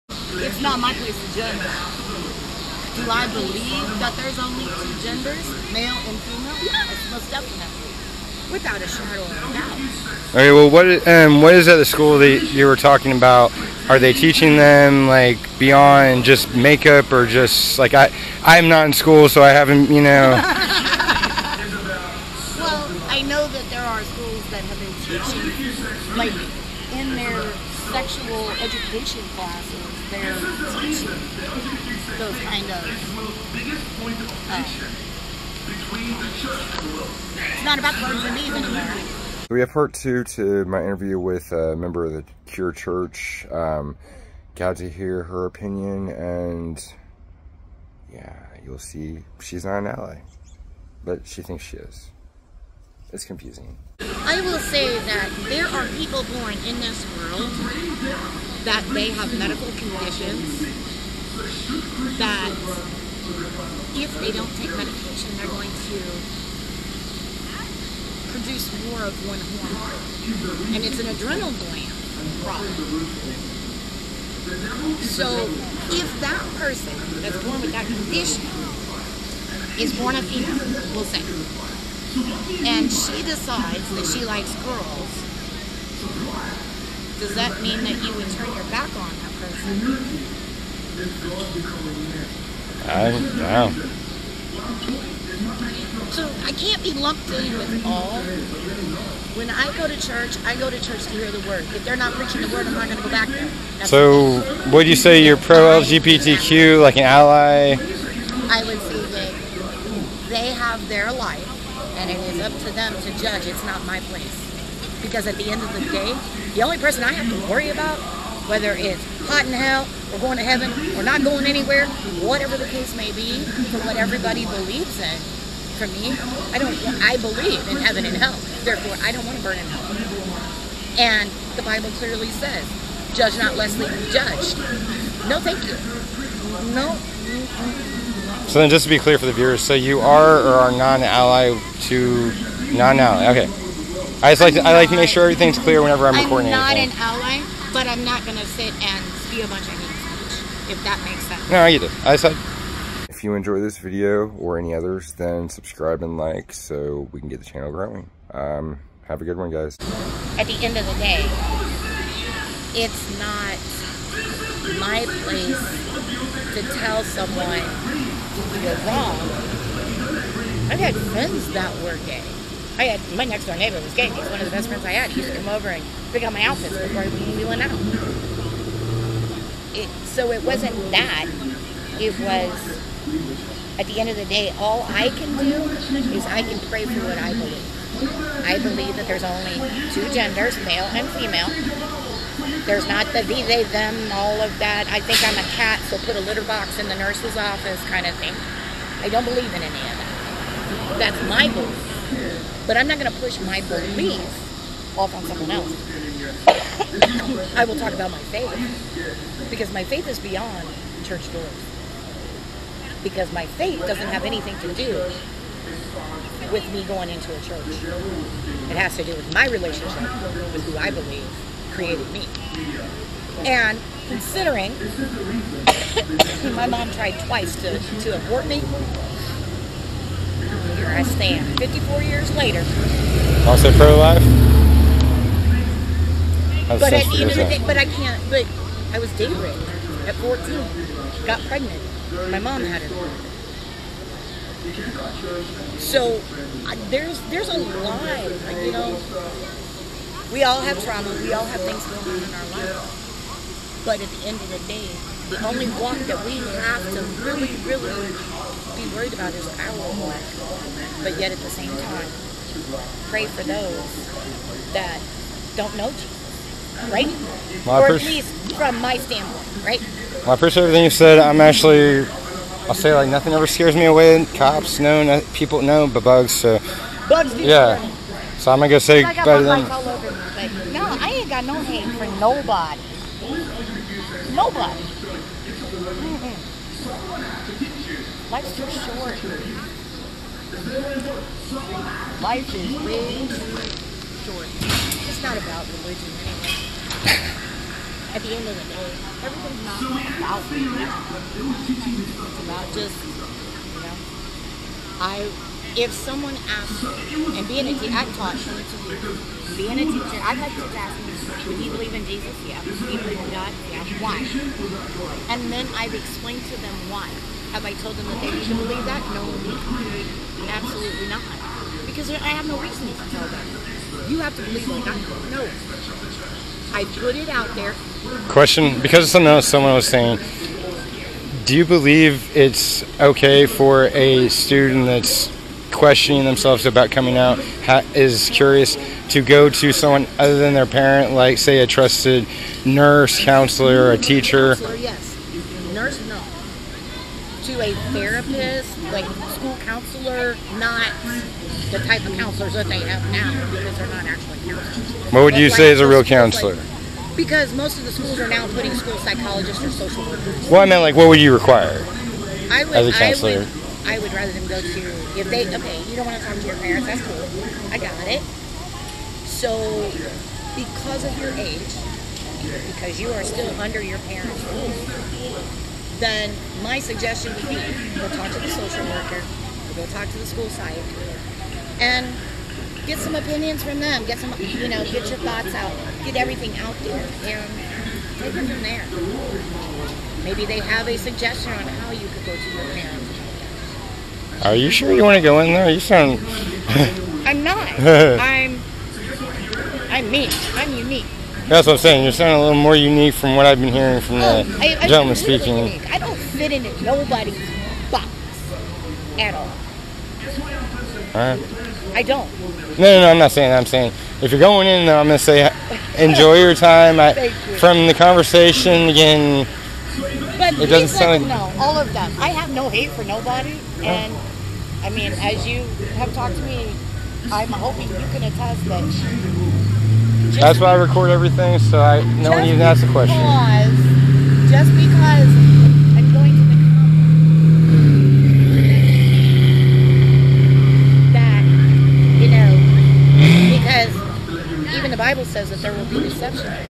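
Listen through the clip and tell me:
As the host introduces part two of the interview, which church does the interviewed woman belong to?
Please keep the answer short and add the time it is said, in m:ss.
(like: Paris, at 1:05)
Cure Church, at 0:42.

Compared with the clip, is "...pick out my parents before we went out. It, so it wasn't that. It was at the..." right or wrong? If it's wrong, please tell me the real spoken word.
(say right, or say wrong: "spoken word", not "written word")
wrong: "outfits", not "parents".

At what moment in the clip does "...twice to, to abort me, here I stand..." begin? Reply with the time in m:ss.
3:47.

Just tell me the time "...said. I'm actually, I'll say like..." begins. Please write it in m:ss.
4:30.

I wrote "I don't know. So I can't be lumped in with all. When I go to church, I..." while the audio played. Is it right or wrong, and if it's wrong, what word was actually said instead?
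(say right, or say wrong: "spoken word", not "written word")
right.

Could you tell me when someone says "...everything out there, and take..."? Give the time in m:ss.
6:26.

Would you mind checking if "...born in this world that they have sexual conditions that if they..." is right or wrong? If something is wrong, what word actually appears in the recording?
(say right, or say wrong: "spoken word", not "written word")
wrong: "medical", not "sexual".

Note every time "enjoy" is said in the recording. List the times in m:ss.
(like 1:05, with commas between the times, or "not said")
2:33, 6:55.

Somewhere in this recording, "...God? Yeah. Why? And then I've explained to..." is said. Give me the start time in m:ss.
5:13.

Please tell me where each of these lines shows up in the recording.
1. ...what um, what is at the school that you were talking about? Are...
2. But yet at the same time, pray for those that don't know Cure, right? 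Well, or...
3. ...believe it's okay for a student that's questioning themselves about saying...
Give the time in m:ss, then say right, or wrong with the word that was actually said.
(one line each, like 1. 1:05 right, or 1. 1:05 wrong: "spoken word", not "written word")
1. 0:10 right
2. 4:21 wrong: "Jesus", not "Cure"
3. 5:31 wrong: "coming", not "saying".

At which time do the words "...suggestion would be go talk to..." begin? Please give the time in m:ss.
6:16.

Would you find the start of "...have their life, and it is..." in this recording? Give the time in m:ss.
1:50.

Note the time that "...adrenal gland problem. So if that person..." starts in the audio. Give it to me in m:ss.
1:11.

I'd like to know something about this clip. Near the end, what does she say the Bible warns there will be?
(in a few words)
Deception.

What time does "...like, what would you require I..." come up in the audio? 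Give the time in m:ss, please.
6:00.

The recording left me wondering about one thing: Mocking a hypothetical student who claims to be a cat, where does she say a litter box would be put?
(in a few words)
The nurse's office.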